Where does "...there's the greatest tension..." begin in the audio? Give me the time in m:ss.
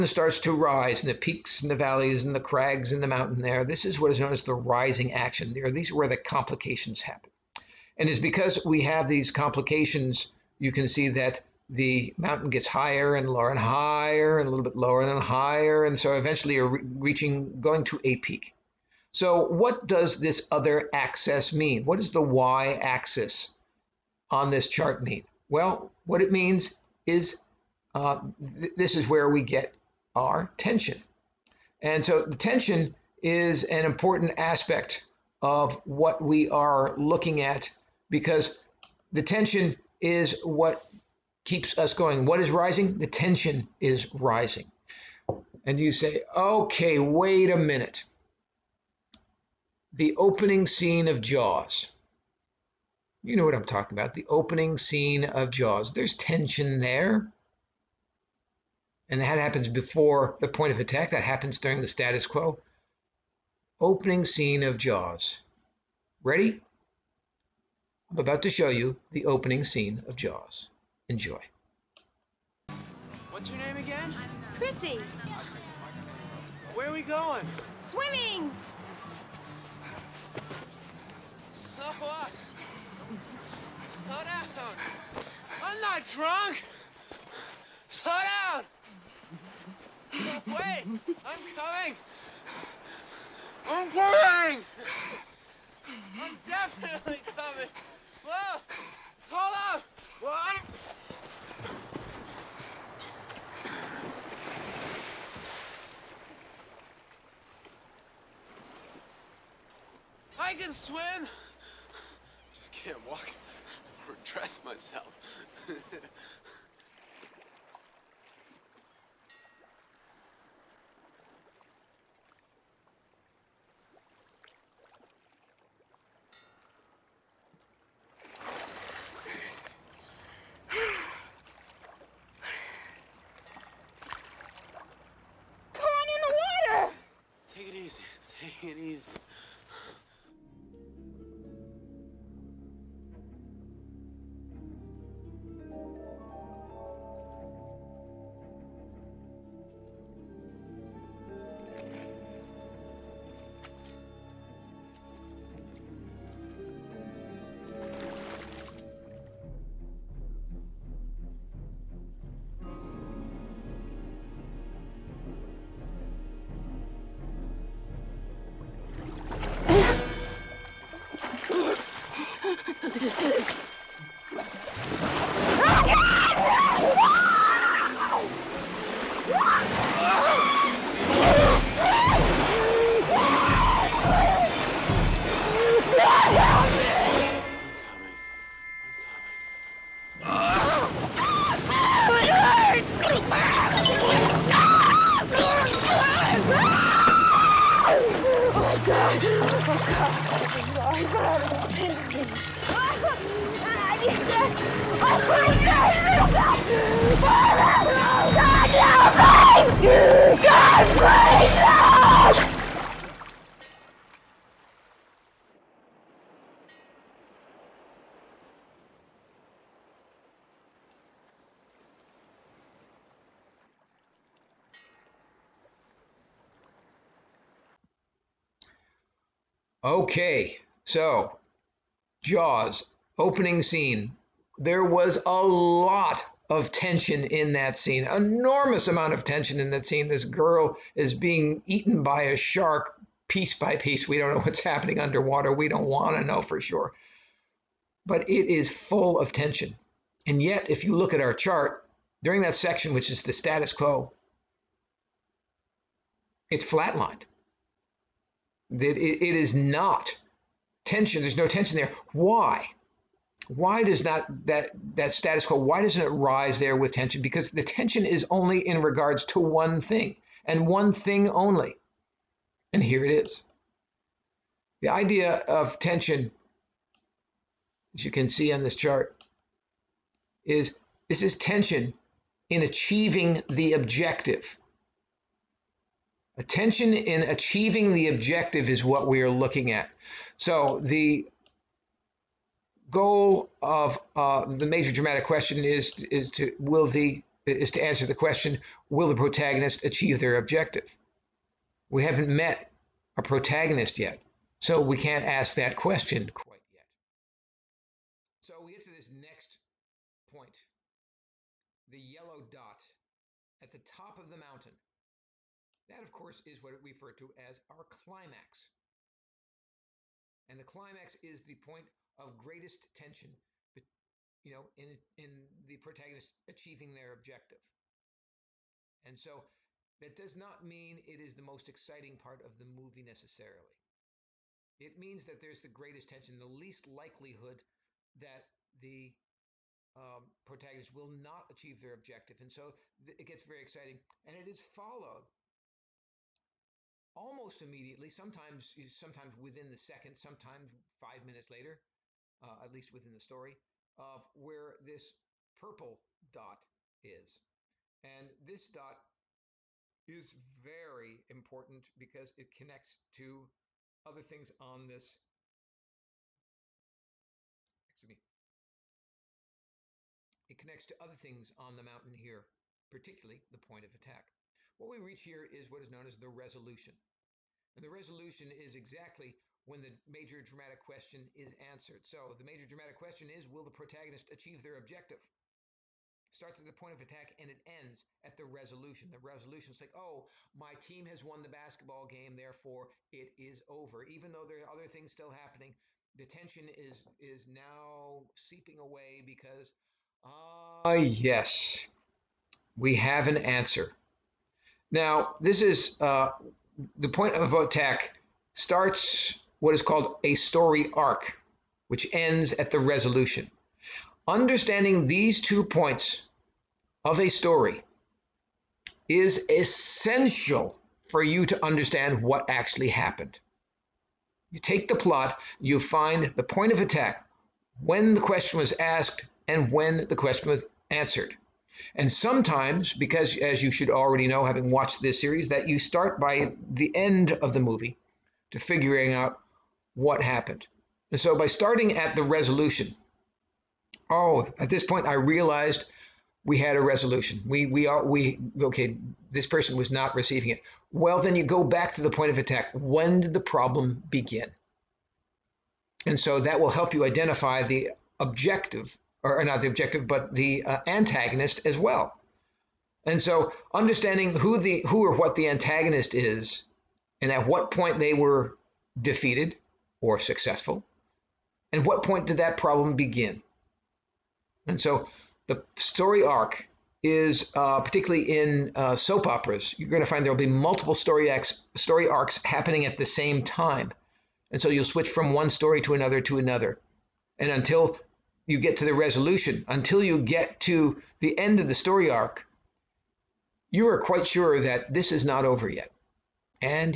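5:35.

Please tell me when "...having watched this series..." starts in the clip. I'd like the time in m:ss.
7:14.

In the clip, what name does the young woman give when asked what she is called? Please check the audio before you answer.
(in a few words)
Chrissy.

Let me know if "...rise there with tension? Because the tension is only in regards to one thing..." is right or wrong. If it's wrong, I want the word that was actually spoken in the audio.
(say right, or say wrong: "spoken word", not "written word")
right.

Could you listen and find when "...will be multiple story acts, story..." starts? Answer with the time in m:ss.
8:00.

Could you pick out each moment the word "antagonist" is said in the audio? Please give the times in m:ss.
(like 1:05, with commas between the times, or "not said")
7:40, 7:45.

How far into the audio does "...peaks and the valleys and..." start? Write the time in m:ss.
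0:01.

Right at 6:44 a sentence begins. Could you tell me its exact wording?
Now, this is uh, the point of attack starts what is called a story arc, which ends at the resolution.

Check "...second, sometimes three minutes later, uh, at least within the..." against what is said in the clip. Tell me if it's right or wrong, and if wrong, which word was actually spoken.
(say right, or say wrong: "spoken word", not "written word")
wrong: "five", not "three".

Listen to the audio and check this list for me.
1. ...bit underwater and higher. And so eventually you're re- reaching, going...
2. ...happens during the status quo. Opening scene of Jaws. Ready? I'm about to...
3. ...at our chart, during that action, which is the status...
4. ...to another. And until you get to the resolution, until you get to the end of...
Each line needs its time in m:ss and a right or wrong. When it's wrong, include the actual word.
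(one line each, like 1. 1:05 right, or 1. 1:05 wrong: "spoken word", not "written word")
1. 0:14 wrong: "lower", not "underwater"
2. 1:01 right
3. 4:11 wrong: "section", not "action"
4. 8:06 right.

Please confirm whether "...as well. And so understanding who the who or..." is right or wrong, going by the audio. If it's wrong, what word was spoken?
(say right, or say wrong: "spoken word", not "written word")
right.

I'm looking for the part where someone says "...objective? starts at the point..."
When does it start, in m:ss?
6:24.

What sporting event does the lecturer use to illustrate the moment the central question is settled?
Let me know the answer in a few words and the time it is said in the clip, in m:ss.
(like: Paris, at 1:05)
basketball game, at 6:31.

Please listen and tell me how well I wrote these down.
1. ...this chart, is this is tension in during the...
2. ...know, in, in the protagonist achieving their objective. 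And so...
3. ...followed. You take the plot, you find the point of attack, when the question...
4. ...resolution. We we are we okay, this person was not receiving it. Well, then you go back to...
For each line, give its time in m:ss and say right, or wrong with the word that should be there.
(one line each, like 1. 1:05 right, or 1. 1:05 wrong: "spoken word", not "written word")
1. 4:38 wrong: "achieving", not "during"
2. 5:24 right
3. 7:02 wrong: "happened", not "followed"
4. 7:26 right.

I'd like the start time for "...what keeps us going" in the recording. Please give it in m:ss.
0:40.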